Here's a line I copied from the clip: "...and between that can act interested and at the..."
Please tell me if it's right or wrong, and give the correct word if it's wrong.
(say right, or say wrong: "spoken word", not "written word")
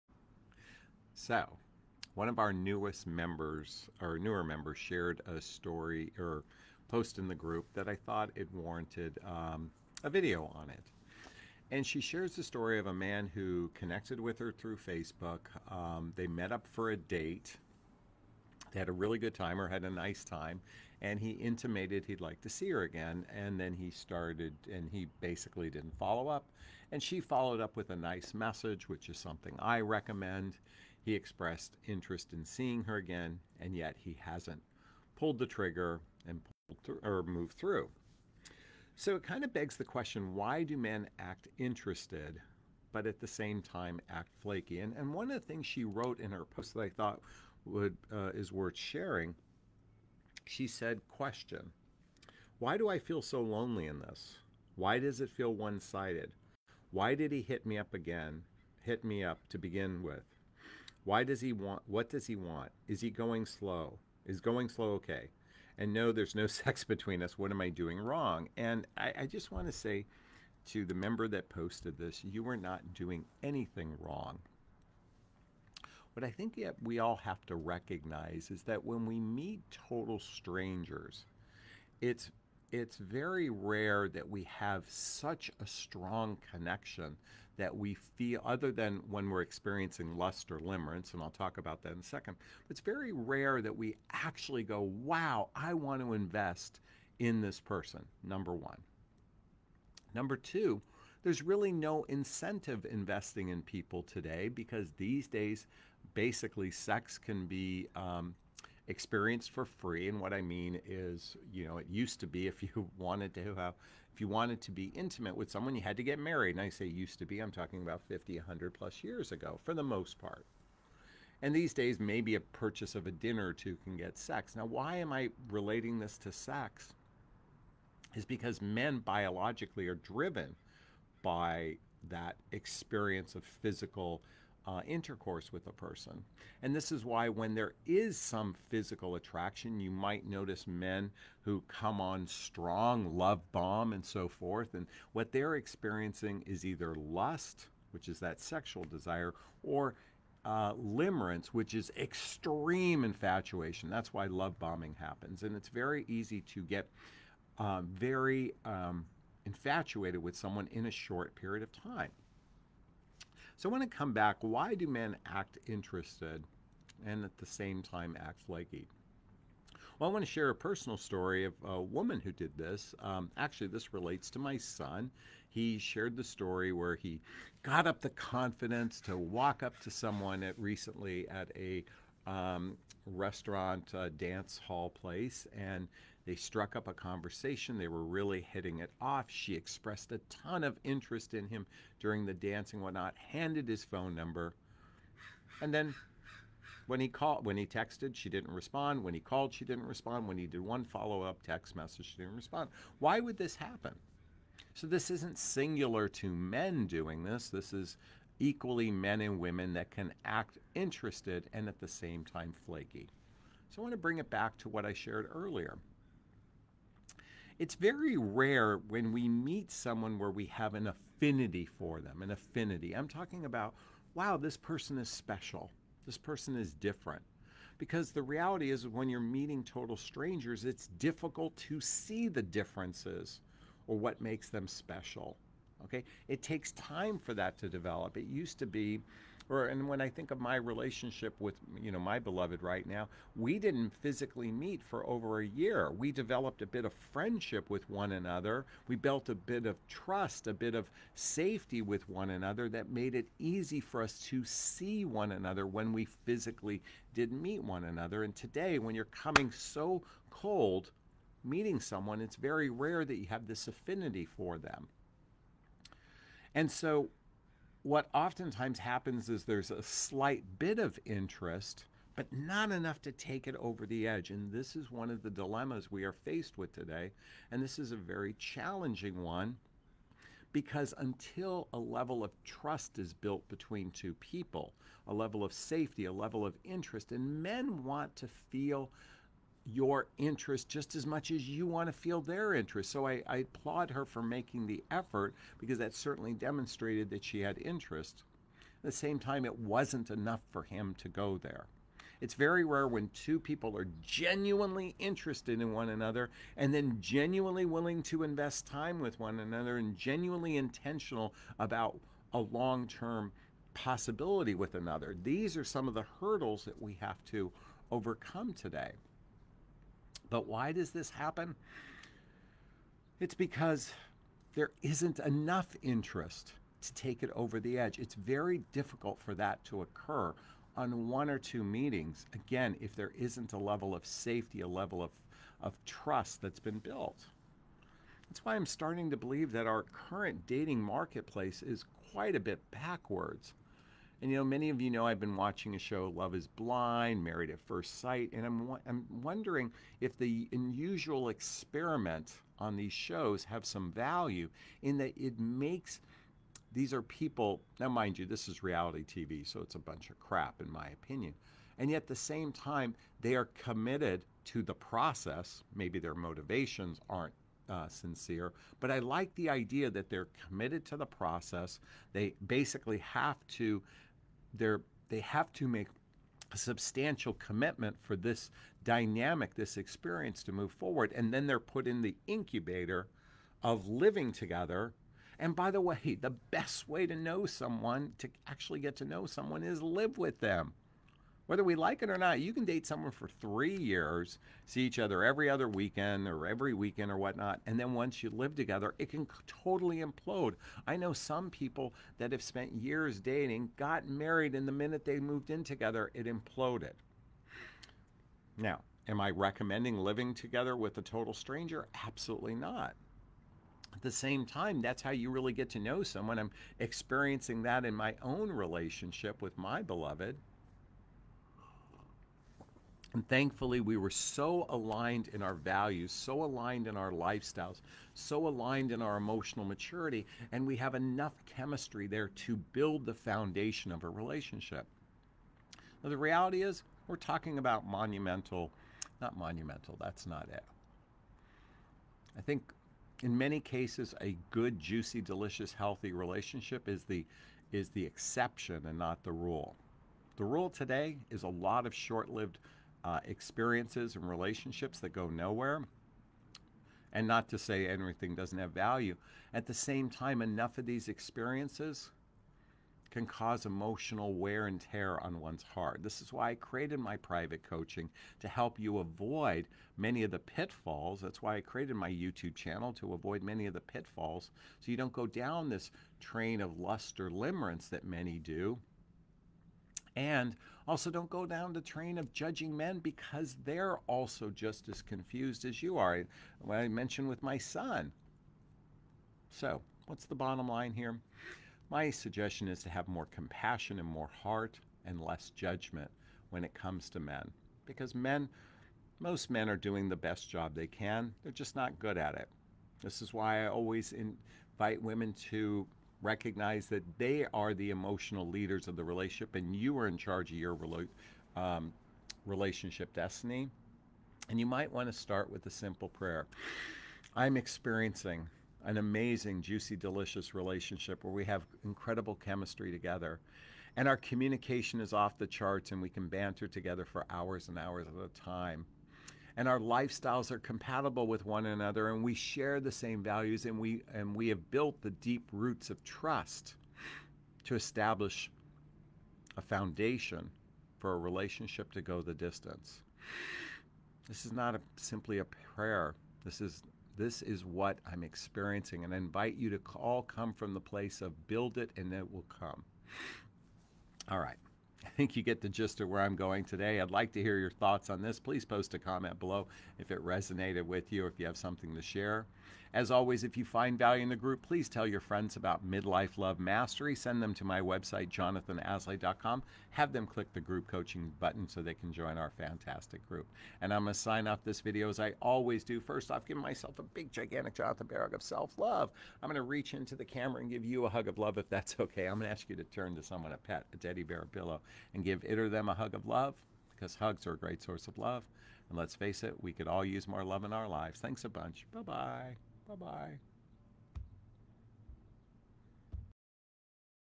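wrong: "women", not "between".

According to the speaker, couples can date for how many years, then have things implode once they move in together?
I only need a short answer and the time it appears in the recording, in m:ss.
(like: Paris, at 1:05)
3 years, at 6:33.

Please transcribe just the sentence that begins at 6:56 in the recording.
I'm experiencing that in my own relationship with my beloved.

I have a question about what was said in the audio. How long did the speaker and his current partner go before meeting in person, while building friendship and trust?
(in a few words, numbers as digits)
Over a year.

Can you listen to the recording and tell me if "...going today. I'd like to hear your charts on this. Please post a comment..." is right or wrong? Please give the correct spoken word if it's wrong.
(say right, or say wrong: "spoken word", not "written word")
wrong: "thoughts", not "charts".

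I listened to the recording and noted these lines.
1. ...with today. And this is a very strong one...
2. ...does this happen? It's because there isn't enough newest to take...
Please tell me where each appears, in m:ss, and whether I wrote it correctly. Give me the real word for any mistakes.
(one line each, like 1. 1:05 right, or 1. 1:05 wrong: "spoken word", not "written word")
1. 4:36 wrong: "challenging", not "strong"
2. 5:20 wrong: "interest", not "newest".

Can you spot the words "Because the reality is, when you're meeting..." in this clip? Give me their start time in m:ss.
3:47.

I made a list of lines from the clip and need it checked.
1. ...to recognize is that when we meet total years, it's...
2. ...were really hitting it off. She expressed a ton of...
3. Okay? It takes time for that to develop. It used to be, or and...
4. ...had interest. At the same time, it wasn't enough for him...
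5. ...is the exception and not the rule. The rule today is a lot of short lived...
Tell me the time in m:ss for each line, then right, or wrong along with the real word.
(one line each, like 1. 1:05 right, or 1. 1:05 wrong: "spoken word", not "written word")
1. 1:17 wrong: "strangers", not "years"
2. 3:07 right
3. 3:55 right
4. 4:57 right
5. 7:27 right.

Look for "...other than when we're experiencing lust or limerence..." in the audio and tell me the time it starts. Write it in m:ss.
1:28.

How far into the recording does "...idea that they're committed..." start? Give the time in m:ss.
6:09.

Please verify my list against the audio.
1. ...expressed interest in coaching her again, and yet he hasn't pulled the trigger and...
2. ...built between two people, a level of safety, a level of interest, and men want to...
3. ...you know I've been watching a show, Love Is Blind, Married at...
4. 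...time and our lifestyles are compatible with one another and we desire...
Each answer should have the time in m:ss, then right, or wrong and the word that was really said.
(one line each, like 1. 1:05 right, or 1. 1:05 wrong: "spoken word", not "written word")
1. 0:31 wrong: "seeing", not "coaching"
2. 4:43 right
3. 5:44 right
4. 8:48 wrong: "share", not "desire".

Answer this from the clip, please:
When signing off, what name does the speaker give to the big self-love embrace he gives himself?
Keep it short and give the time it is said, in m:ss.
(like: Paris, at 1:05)
Jonathon Bear, at 9:37.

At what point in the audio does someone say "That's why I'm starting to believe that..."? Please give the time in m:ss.
5:38.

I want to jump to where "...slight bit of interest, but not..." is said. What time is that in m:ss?
4:29.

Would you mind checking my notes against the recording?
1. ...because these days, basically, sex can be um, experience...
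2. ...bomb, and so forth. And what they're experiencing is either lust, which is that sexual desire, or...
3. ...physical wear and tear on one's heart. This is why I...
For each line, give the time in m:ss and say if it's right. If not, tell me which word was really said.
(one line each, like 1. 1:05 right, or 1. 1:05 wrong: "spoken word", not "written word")
1. 1:44 right
2. 2:23 right
3. 7:43 wrong: "emotional", not "physical".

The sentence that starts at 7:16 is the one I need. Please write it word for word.
Now, the reality is, we're talking about monumental, not monumental, that's not it.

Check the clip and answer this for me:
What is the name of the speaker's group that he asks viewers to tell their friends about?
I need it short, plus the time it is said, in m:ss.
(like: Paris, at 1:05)
Midlife Love Mastery, at 9:25.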